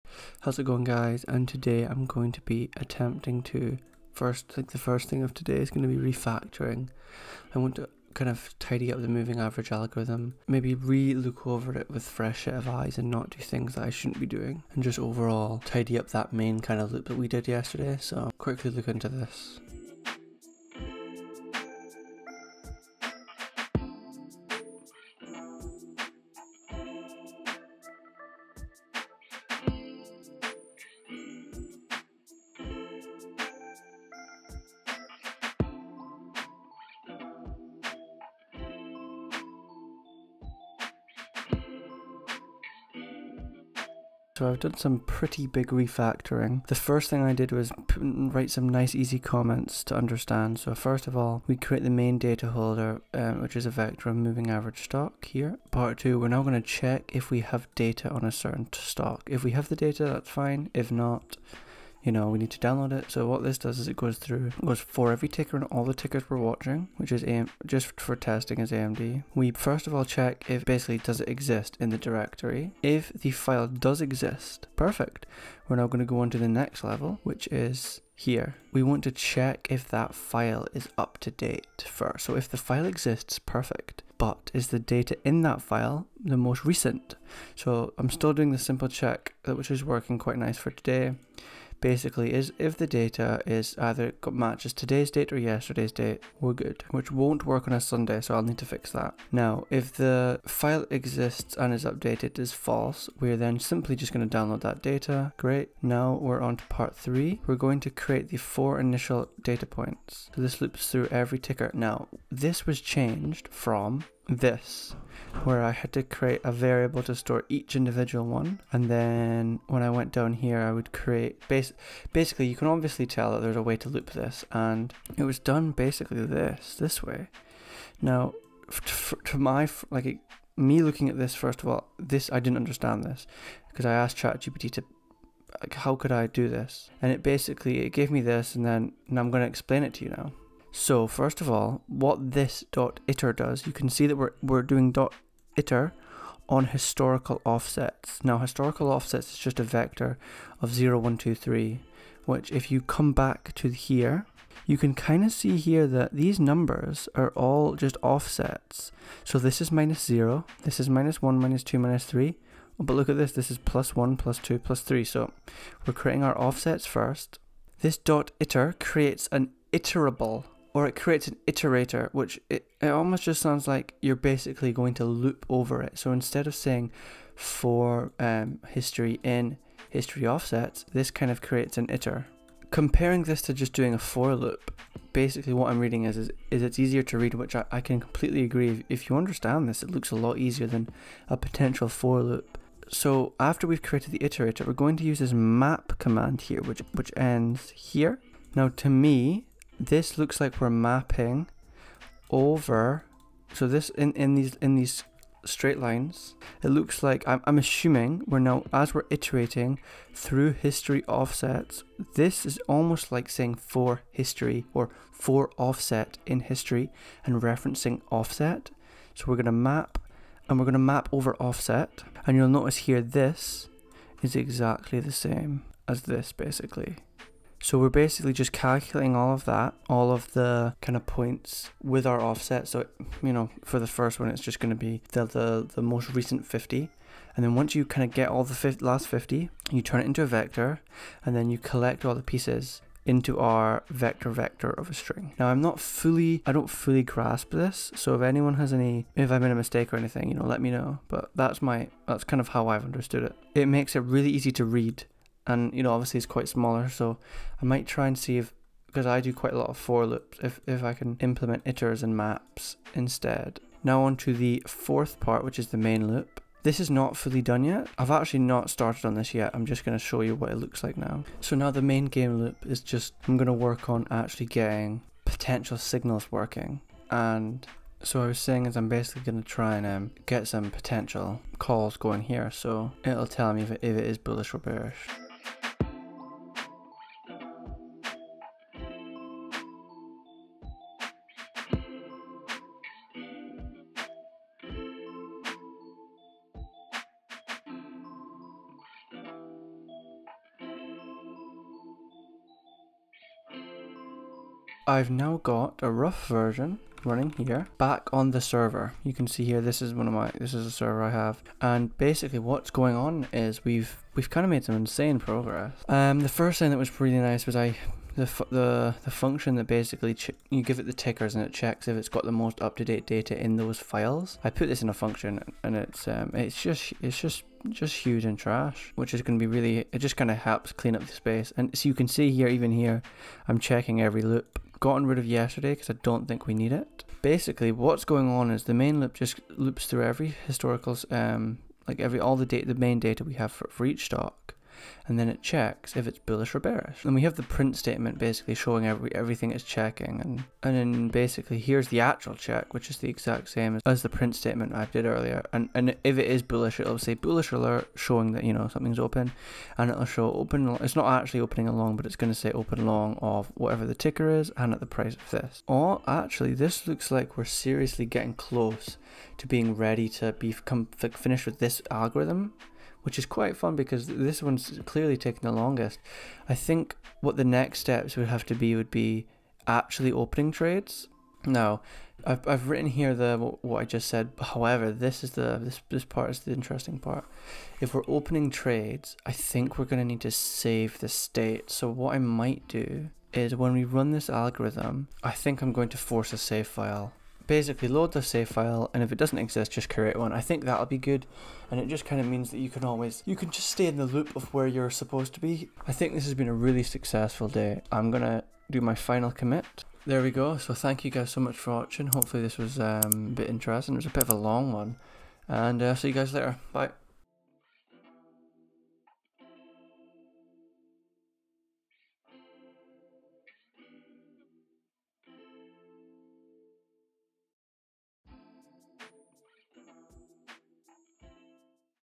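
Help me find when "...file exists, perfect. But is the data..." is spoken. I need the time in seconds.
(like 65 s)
82 s.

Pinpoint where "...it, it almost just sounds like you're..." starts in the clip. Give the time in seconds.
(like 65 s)
172 s.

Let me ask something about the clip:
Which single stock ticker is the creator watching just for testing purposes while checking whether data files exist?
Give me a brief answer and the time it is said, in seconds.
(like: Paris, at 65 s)
AMD, at 68 s.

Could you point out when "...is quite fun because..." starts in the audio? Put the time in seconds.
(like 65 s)
373 s.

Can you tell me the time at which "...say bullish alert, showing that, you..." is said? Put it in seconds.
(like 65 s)
356 s.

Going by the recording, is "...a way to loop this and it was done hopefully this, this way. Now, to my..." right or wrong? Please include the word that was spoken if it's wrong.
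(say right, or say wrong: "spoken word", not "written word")
wrong: "basically", not "hopefully".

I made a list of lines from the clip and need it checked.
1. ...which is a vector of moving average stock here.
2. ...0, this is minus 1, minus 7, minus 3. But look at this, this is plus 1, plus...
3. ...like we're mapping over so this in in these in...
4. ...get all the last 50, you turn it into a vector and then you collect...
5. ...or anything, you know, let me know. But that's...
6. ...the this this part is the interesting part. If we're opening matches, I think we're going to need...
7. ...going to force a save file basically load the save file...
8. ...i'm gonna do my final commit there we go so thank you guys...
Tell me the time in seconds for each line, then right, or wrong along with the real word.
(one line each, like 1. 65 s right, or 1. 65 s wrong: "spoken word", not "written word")
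1. 53 s right
2. 160 s wrong: "2", not "7"
3. 200 s right
4. 238 s right
5. 249 s right
6. 385 s wrong: "trades", not "matches"
7. 395 s right
8. 407 s right.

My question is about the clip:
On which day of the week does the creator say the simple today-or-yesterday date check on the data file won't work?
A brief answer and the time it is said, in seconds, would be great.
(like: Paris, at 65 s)
Sunday, at 97 s.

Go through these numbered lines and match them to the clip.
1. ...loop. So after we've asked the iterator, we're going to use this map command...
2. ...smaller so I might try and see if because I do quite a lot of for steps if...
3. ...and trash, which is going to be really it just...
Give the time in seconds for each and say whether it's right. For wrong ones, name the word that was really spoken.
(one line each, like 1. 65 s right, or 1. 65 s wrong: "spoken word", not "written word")
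1. 192 s wrong: "created", not "asked"
2. 256 s wrong: "loops", not "steps"
3. 328 s right.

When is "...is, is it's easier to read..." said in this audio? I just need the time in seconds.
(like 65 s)
186 s.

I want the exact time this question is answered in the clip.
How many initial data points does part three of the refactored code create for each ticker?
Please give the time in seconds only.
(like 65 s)
108 s.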